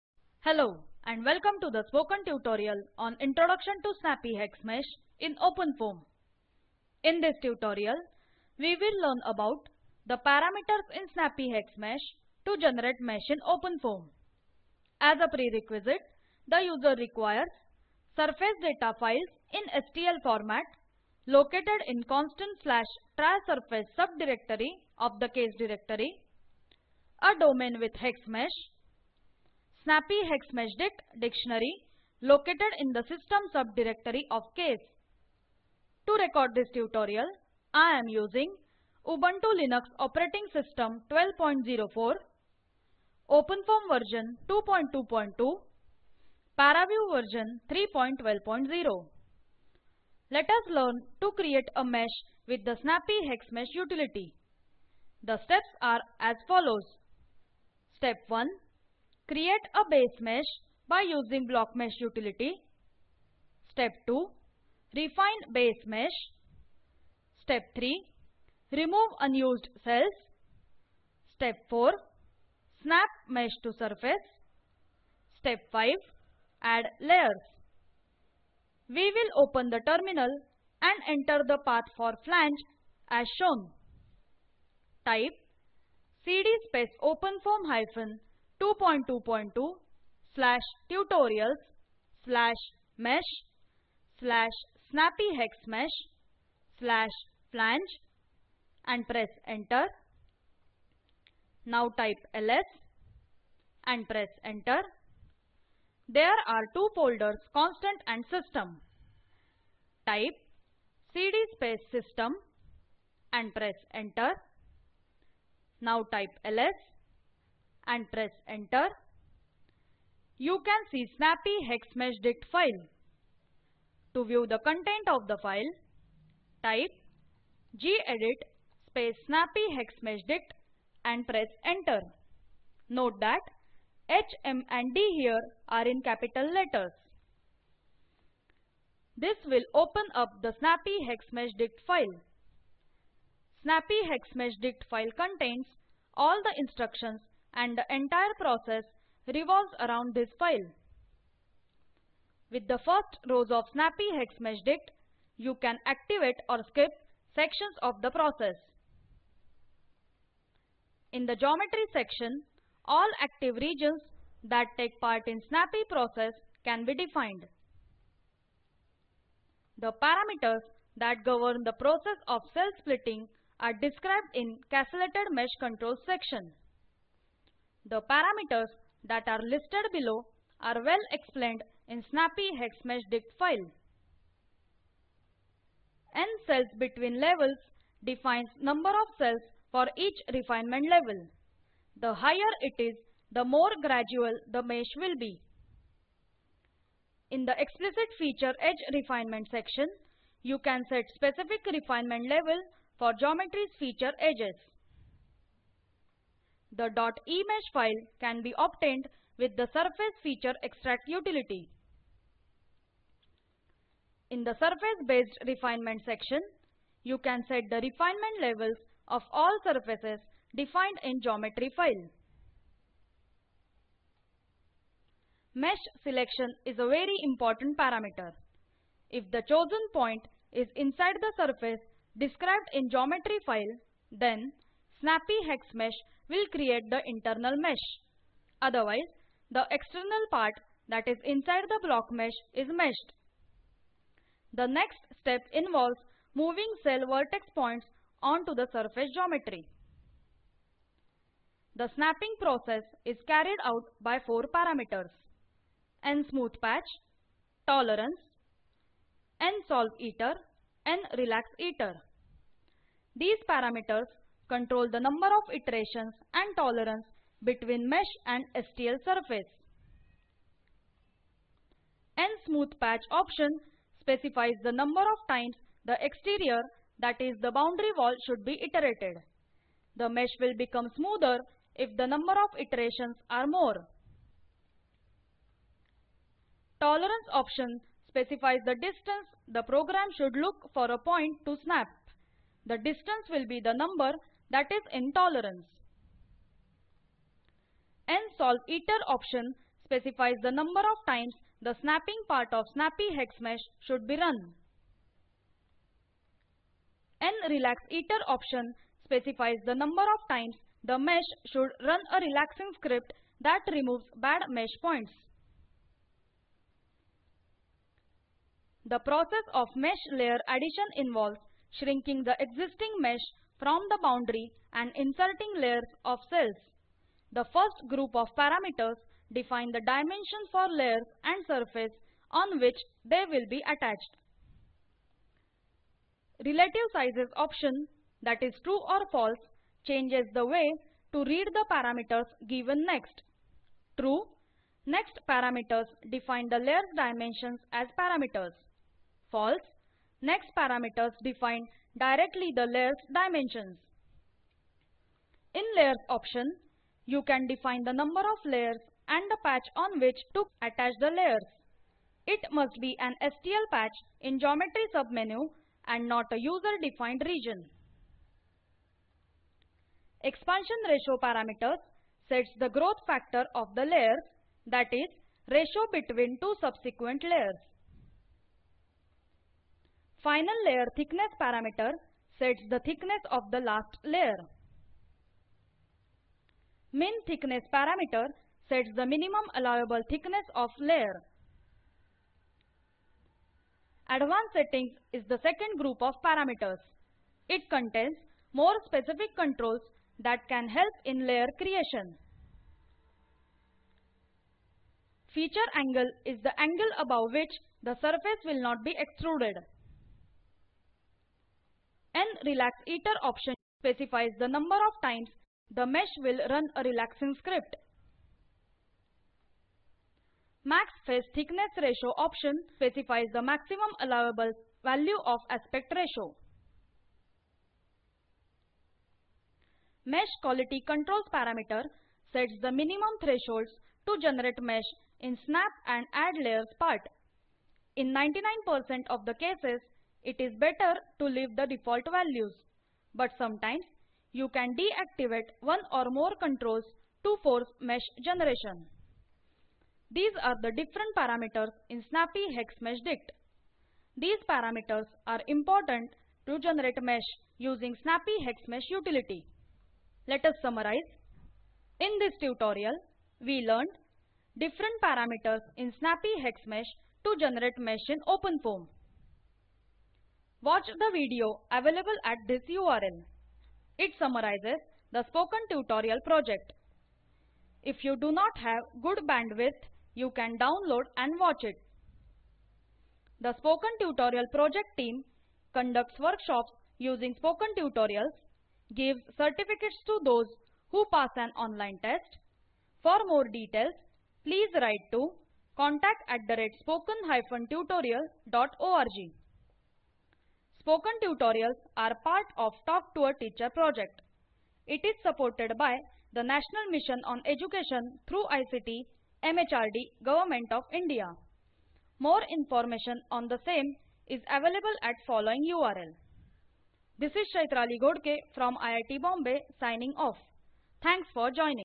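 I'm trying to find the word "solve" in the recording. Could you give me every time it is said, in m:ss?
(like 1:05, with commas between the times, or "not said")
4:19, 4:58.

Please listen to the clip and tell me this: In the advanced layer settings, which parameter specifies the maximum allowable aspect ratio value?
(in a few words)
Max face thickness ratio.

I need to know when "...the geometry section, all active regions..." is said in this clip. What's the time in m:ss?
2:41.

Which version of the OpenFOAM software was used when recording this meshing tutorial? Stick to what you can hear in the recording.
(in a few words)
2.2.2.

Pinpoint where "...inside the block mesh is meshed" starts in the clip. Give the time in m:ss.
4:01.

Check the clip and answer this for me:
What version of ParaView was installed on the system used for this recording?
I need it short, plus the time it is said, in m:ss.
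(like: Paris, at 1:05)
3.12.0, at 0:46.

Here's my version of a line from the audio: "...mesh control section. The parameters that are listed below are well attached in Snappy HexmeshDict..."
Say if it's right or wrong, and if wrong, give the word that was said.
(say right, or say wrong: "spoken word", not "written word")
wrong: "explained", not "attached".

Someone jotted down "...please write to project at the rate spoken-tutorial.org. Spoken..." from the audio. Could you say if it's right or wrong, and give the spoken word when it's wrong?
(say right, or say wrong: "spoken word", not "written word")
wrong: "contact", not "project".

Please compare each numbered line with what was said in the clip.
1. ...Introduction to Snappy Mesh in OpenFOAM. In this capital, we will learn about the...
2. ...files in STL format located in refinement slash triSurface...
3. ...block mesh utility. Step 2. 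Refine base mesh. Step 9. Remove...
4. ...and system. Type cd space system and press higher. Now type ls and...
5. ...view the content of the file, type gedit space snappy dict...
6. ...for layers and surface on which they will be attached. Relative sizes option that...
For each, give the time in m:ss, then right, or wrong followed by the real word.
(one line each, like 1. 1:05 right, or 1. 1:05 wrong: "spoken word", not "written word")
1. 0:03 wrong: "tutorial", not "capital"
2. 0:18 wrong: "constant", not "refinement"
3. 1:01 wrong: "3", not "9"
4. 1:48 wrong: "enter", not "higher"
5. 2:04 right
6. 5:30 right.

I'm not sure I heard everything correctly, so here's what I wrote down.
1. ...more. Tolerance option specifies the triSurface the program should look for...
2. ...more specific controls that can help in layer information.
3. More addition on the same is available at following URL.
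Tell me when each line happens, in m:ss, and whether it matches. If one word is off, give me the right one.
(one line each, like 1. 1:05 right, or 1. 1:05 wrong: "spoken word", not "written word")
1. 4:43 wrong: "distance", not "triSurface"
2. 6:38 wrong: "creation", not "information"
3. 8:32 wrong: "information", not "addition".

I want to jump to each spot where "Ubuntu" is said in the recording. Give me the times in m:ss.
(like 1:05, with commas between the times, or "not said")
0:39.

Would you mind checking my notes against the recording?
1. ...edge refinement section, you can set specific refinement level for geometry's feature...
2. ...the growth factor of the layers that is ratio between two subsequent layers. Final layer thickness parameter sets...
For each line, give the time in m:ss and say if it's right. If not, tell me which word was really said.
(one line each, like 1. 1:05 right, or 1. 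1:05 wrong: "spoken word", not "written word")
1. 3:18 right
2. 6:12 right.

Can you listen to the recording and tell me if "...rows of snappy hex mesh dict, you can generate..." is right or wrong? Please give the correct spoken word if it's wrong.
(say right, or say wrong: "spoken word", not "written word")
wrong: "activate", not "generate".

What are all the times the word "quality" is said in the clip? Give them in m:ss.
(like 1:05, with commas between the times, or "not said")
7:10.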